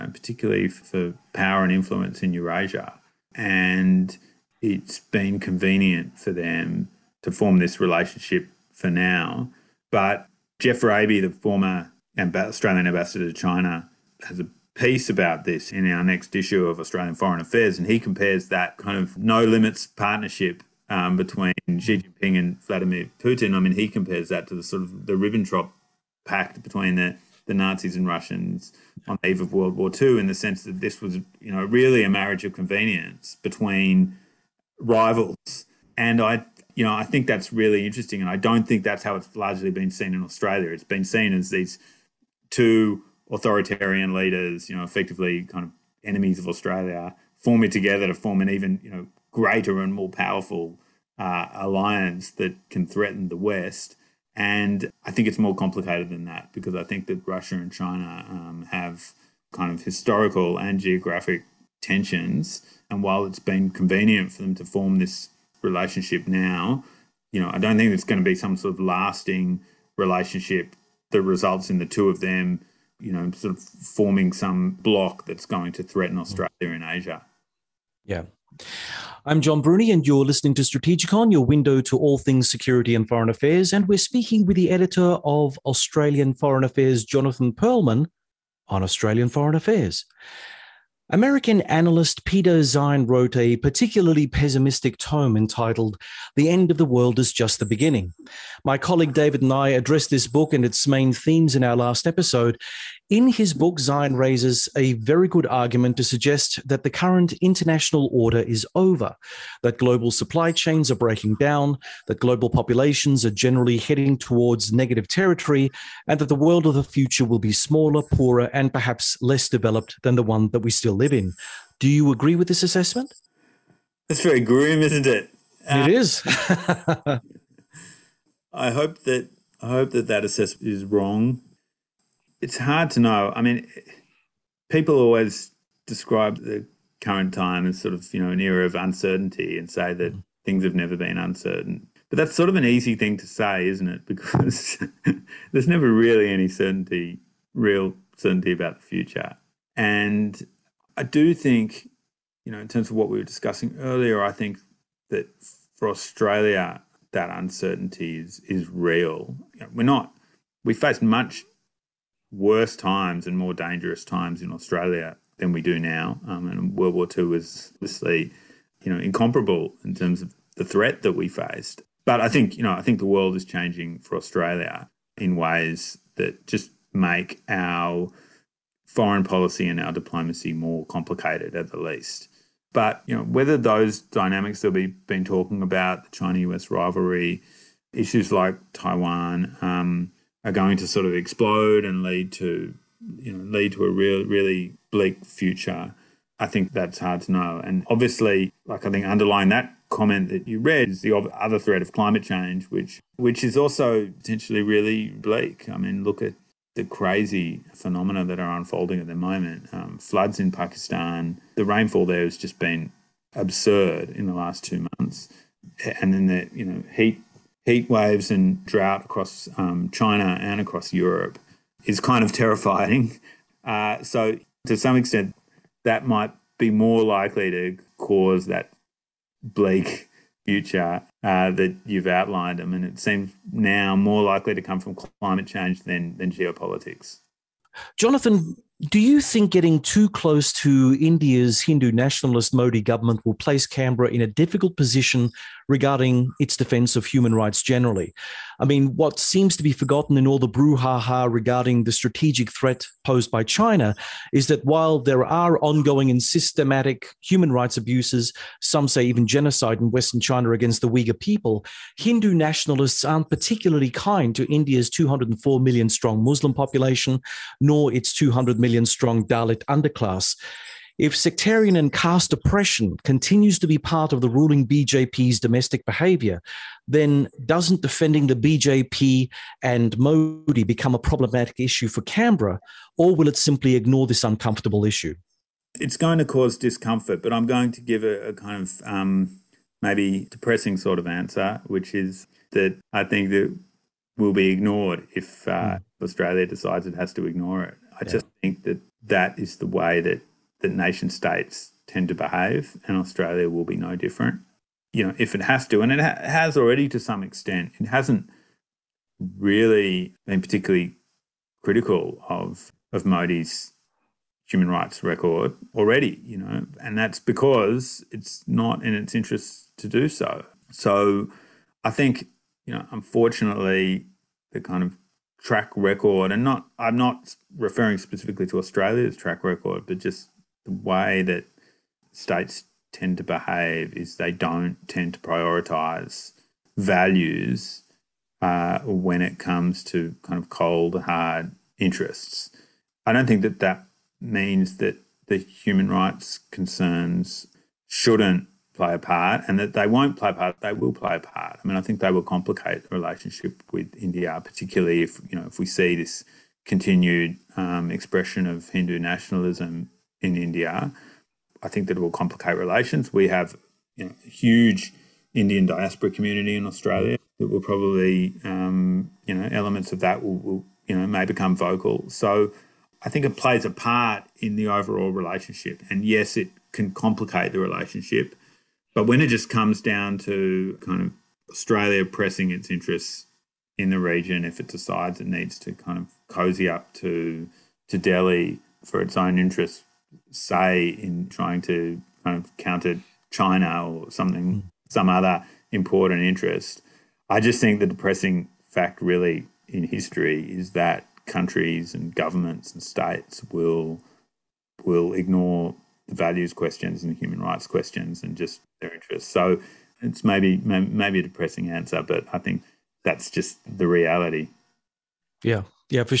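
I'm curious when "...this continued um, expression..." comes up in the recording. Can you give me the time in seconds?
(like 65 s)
355 s.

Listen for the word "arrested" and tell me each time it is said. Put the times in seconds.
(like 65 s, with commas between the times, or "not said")
not said.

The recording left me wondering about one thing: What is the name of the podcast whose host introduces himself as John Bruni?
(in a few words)
Strategikon.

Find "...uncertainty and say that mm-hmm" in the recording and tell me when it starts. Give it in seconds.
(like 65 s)
138 s.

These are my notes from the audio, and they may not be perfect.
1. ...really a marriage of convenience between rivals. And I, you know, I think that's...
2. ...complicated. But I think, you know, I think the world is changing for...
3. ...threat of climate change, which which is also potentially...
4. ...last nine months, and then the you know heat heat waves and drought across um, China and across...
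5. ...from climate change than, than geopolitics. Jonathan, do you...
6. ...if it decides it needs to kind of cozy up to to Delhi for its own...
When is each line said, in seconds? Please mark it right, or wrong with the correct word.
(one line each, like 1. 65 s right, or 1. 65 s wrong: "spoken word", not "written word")
1. 31 s right
2. 171 s wrong: "faced", not "complicated"
3. 201 s right
4. 214 s wrong: "two", not "nine"
5. 234 s right
6. 384 s right.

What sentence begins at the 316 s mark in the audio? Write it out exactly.
You know, and that's because it's not in its interest to do so.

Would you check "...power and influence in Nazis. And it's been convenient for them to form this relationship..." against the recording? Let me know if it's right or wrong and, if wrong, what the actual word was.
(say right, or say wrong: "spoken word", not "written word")
wrong: "Eurasia", not "Nazis".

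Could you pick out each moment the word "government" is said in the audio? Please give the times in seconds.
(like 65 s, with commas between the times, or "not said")
242 s, 402 s.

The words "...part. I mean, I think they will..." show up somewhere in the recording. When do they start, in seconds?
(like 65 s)
351 s.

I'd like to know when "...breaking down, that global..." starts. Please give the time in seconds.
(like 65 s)
110 s.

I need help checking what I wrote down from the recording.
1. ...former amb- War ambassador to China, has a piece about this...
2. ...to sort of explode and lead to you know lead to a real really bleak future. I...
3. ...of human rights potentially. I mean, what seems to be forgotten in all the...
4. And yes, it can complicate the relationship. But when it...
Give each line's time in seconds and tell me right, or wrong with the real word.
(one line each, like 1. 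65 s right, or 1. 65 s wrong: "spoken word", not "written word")
1. 11 s wrong: "Australian", not "War"
2. 190 s right
3. 246 s wrong: "generally", not "potentially"
4. 375 s right.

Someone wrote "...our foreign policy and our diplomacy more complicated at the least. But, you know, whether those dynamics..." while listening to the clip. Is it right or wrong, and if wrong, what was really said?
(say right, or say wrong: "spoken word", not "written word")
right.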